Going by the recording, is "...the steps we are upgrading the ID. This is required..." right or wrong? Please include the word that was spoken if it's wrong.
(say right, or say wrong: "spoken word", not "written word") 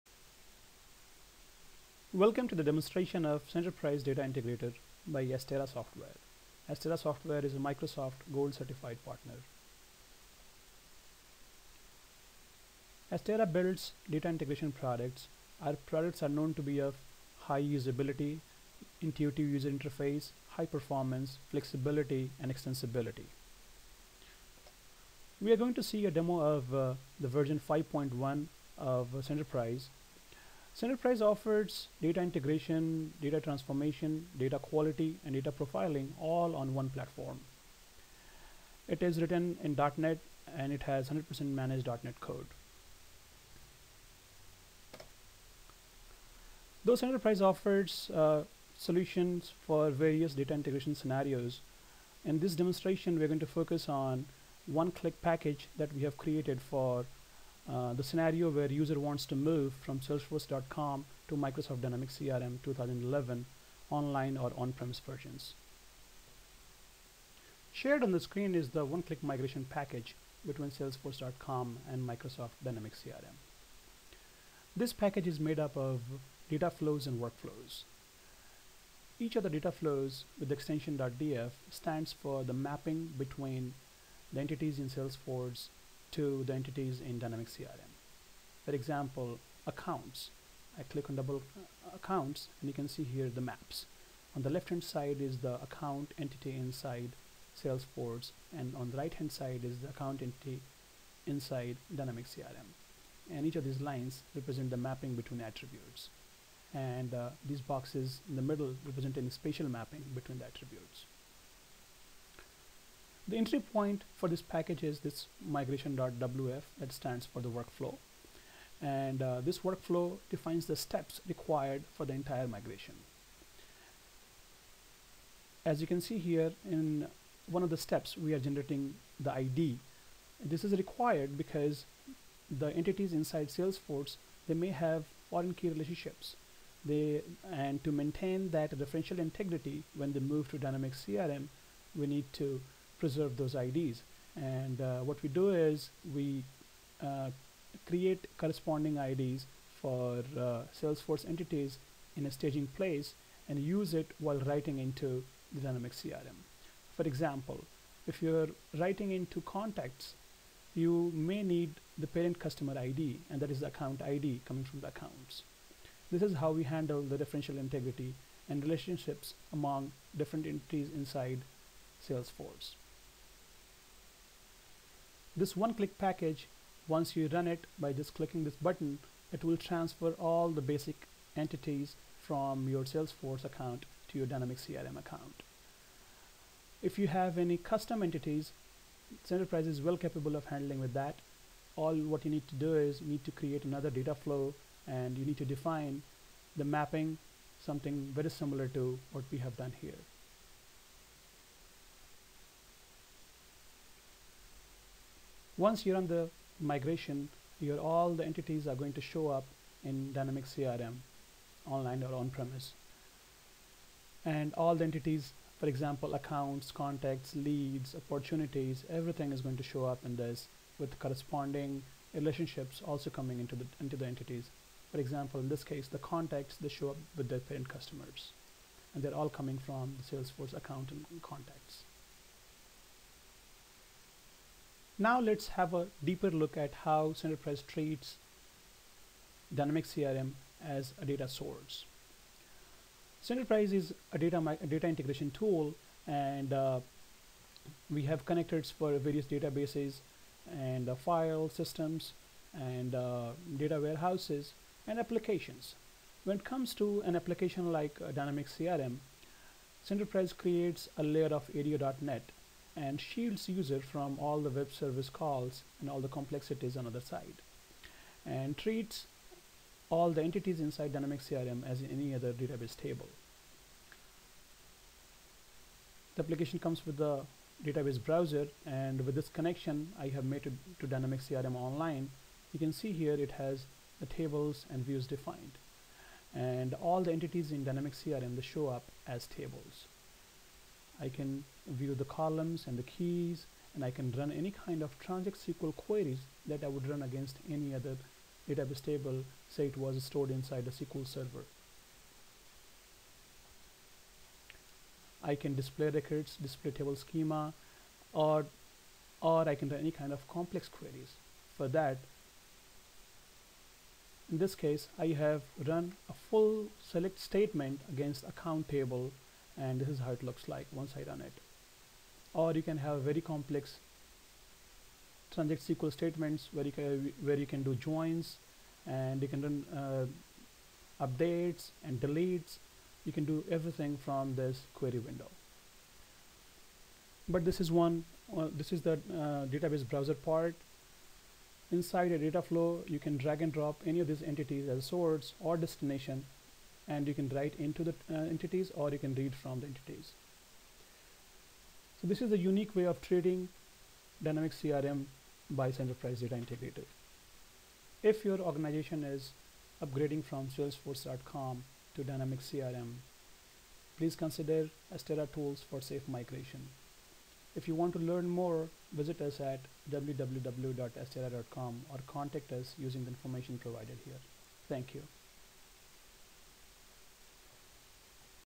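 wrong: "generating", not "upgrading".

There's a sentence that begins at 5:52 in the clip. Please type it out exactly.
So this is a unique way of trading Dynamics CRM by Centerprise Data Integrator.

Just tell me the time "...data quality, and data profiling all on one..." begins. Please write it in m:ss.
0:34.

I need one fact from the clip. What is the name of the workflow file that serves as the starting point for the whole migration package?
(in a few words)
migration.wf.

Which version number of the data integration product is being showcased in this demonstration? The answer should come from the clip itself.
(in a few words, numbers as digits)
5.1.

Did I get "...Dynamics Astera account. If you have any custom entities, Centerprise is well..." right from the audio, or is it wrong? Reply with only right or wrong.
wrong.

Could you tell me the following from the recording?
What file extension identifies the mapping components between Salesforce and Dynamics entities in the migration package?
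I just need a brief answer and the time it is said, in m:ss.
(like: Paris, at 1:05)
.df, at 1:20.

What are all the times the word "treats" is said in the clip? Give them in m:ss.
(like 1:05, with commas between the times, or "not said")
3:57, 4:28.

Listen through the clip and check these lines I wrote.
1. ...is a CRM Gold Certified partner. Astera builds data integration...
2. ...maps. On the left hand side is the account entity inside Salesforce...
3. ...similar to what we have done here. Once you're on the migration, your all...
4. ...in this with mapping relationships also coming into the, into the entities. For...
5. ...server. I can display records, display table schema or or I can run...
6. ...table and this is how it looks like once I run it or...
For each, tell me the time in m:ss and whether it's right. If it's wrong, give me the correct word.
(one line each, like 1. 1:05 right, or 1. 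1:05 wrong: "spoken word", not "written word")
1. 0:07 wrong: "Microsoft", not "CRM"
2. 1:33 right
3. 3:18 right
4. 3:40 wrong: "corresponding", not "mapping"
5. 5:01 right
6. 5:18 right.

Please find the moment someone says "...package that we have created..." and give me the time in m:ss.
0:55.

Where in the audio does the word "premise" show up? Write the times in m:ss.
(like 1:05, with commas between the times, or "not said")
1:04, 3:32.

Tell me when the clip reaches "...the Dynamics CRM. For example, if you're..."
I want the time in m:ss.
2:35.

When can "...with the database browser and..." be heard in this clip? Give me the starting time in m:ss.
4:36.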